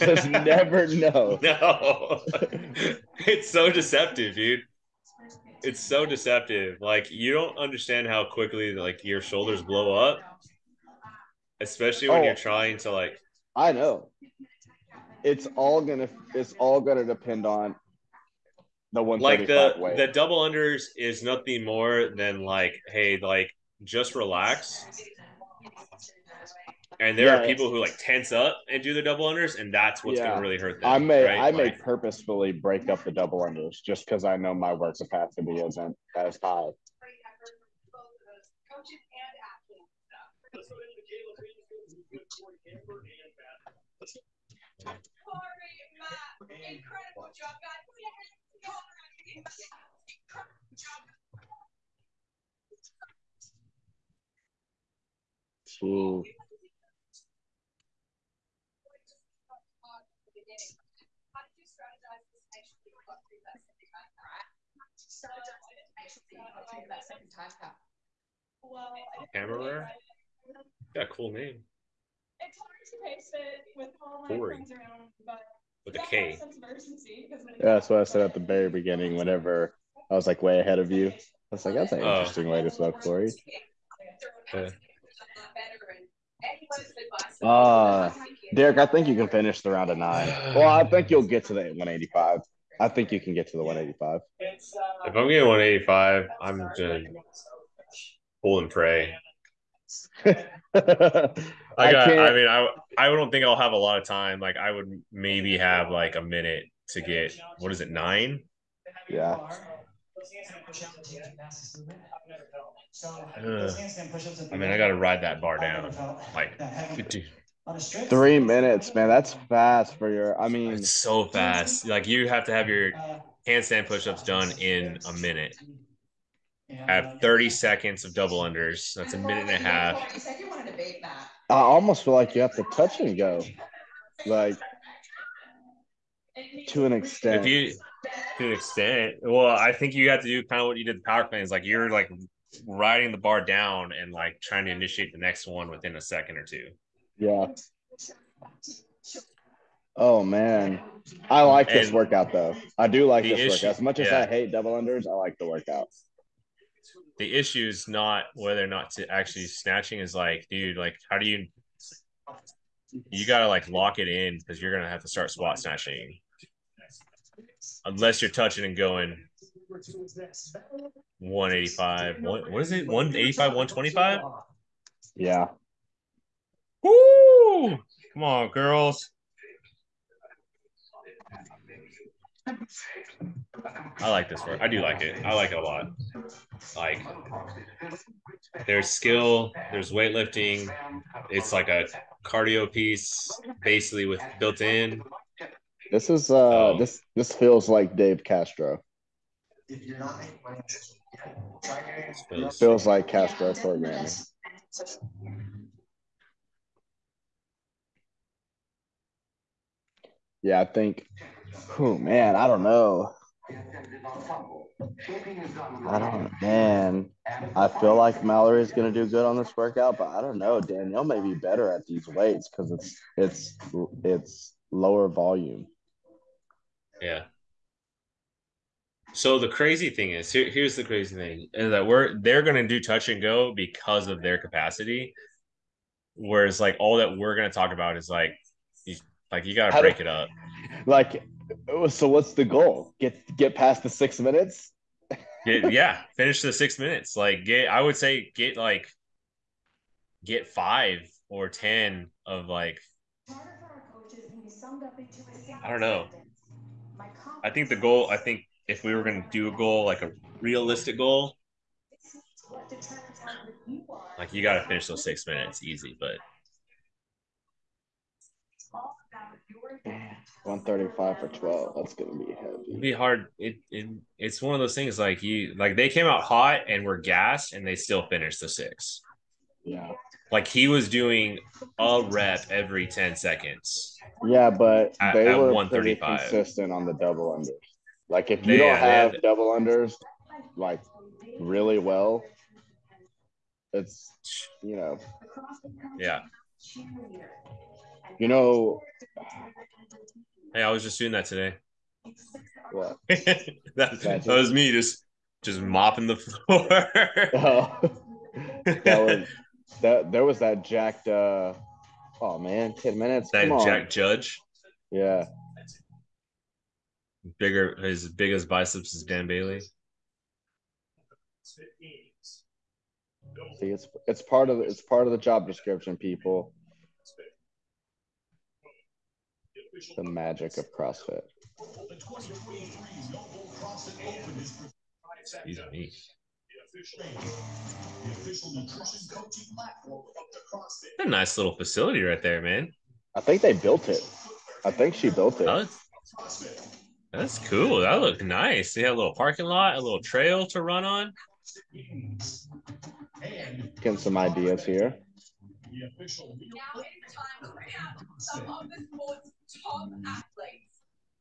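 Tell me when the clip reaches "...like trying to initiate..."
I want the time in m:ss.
2:24.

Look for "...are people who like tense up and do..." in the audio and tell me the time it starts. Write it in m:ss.
0:27.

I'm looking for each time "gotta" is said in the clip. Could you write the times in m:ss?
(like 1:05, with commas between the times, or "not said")
2:43, 3:59.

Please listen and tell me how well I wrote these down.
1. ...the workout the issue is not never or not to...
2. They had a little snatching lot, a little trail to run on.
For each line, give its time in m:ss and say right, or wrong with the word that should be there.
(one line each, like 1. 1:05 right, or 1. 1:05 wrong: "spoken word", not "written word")
1. 2:35 wrong: "whether", not "never"
2. 5:48 wrong: "parking", not "snatching".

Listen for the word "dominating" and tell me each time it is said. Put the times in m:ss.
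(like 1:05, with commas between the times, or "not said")
not said.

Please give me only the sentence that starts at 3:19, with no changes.
If you not money, feels, feels like Castro me.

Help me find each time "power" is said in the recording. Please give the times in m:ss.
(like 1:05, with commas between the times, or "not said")
2:21.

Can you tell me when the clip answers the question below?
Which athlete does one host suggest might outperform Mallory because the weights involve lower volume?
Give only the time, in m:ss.
3:40.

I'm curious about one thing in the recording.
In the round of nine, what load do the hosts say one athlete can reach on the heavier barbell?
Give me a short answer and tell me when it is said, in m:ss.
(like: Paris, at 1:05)
185, at 1:32.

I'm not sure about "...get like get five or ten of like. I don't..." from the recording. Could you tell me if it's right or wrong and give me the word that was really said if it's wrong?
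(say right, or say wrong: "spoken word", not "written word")
right.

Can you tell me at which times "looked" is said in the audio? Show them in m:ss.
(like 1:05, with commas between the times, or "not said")
5:47.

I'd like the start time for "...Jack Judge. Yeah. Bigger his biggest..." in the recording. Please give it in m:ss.
5:13.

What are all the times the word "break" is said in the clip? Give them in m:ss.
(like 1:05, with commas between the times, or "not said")
0:32, 3:59.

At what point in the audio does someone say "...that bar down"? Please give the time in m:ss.
1:55.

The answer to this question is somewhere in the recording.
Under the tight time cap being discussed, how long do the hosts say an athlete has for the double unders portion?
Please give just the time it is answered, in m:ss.
2:06.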